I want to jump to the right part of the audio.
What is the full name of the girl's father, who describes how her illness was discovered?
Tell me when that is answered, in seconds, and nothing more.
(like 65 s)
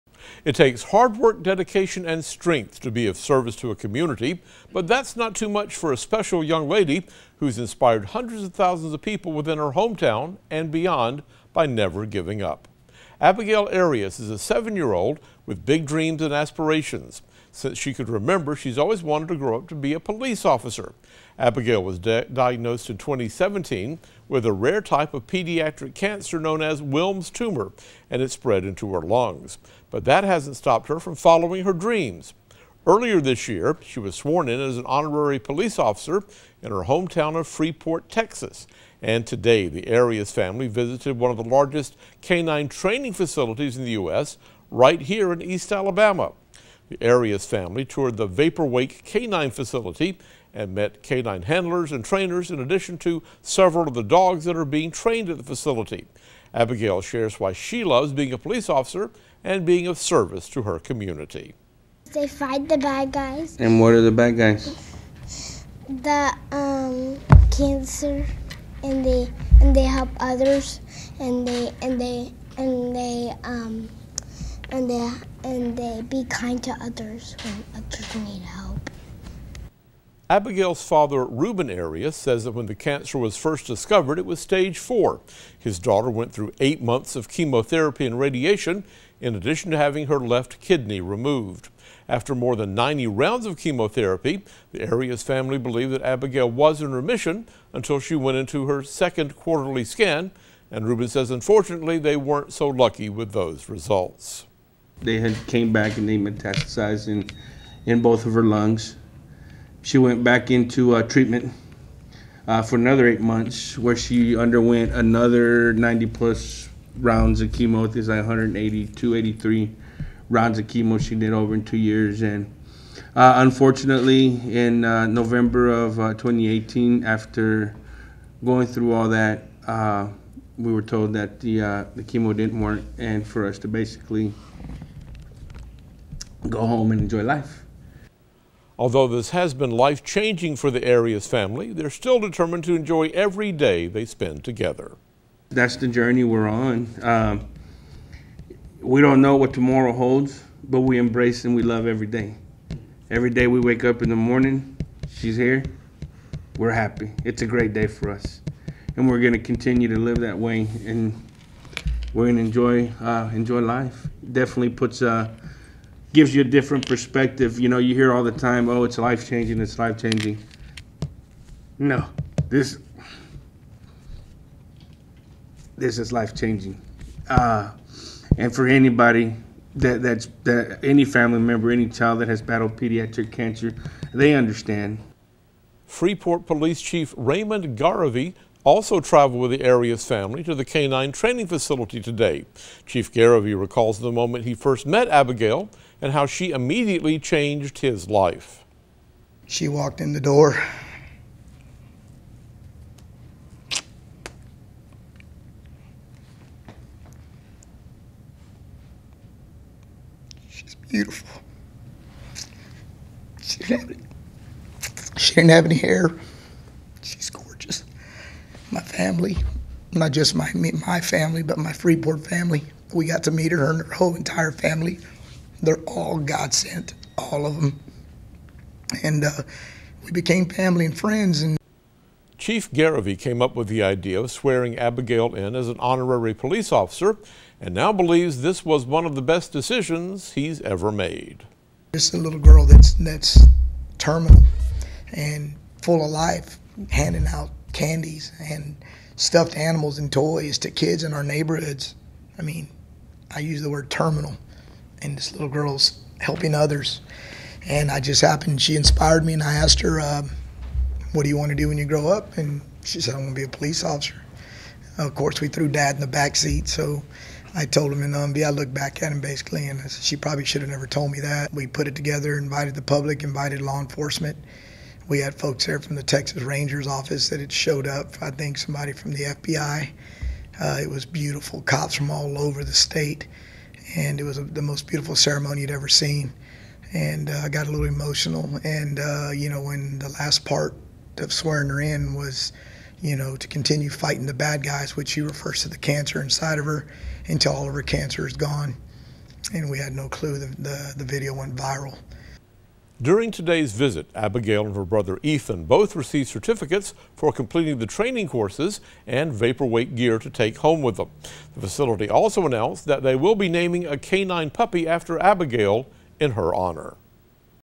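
81 s.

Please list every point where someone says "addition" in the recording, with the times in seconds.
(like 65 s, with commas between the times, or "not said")
52 s, 89 s.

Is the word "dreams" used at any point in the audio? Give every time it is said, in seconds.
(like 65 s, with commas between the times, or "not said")
15 s, 31 s.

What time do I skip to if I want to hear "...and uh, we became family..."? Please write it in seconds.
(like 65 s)
229 s.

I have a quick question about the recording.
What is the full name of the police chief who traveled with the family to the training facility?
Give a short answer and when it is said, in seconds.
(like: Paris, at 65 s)
Raymond Garivey, at 187 s.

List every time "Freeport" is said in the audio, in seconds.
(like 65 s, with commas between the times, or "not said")
37 s, 185 s, 221 s.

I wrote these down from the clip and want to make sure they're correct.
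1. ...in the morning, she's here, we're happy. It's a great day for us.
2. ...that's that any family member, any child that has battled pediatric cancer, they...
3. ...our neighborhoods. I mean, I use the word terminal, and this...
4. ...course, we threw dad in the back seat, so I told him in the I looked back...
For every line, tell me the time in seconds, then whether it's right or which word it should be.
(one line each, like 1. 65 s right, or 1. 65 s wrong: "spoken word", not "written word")
1. 154 s right
2. 180 s right
3. 251 s right
4. 265 s right.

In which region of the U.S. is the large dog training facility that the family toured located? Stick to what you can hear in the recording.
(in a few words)
East Alabama.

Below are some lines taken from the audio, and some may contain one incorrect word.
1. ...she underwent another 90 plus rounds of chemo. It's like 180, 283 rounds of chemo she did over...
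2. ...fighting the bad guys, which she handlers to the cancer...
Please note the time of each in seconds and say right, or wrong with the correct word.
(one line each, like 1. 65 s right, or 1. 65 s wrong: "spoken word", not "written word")
1. 113 s right
2. 293 s wrong: "refers", not "handlers".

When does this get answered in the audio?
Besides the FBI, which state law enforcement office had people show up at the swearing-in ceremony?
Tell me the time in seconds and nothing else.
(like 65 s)
276 s.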